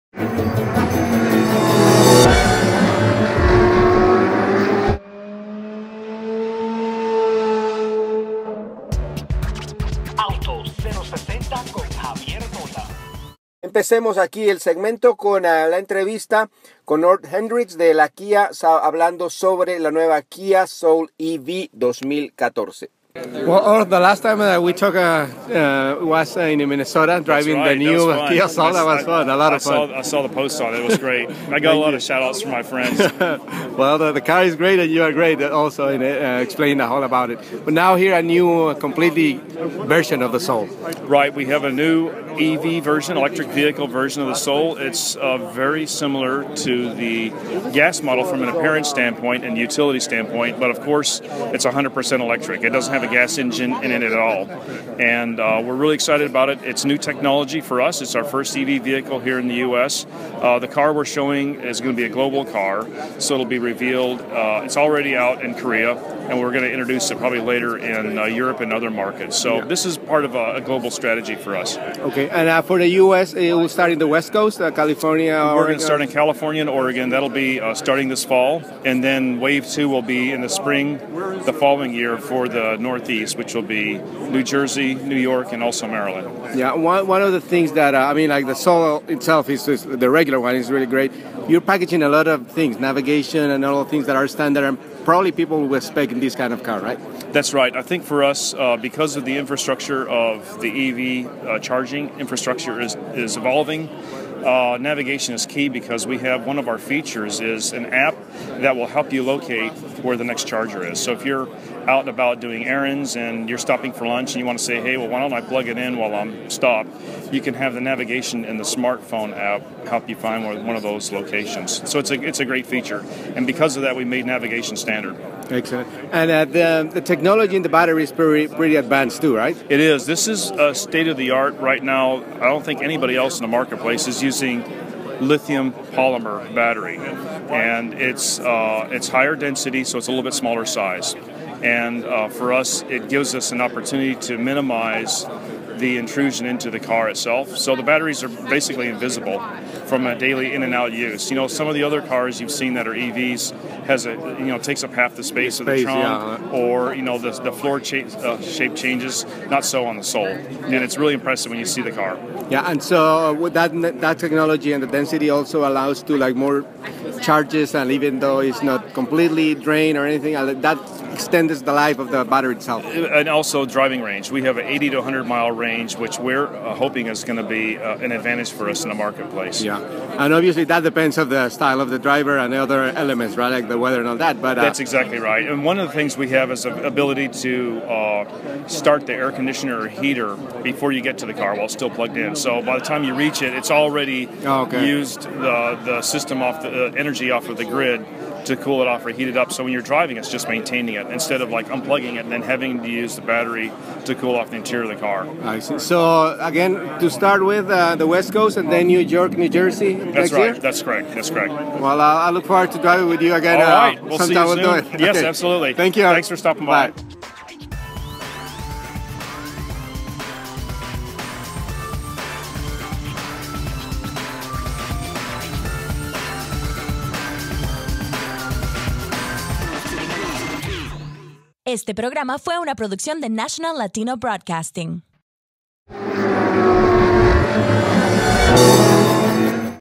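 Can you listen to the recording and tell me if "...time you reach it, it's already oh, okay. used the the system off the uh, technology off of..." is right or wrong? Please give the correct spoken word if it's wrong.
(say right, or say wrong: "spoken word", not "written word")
wrong: "energy", not "technology".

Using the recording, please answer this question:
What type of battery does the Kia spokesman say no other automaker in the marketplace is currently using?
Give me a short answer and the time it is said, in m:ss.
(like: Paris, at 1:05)
lithium polymer, at 2:15.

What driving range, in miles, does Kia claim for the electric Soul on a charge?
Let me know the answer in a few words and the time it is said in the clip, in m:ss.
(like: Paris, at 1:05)
80 to 100 miles, at 2:54.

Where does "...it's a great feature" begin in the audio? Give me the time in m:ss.
2:02.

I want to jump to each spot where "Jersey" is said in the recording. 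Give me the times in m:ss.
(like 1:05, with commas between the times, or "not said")
1:24, 3:29.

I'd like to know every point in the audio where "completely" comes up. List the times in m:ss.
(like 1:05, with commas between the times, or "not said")
0:38, 2:48.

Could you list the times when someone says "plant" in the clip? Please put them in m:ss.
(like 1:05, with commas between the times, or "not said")
not said.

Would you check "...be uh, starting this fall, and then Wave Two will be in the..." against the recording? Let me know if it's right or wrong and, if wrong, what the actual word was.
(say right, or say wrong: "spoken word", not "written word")
right.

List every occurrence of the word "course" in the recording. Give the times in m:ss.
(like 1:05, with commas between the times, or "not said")
0:50.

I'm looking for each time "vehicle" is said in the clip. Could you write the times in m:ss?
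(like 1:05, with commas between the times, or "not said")
0:43, 0:58.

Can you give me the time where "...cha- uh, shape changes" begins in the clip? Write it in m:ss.
2:37.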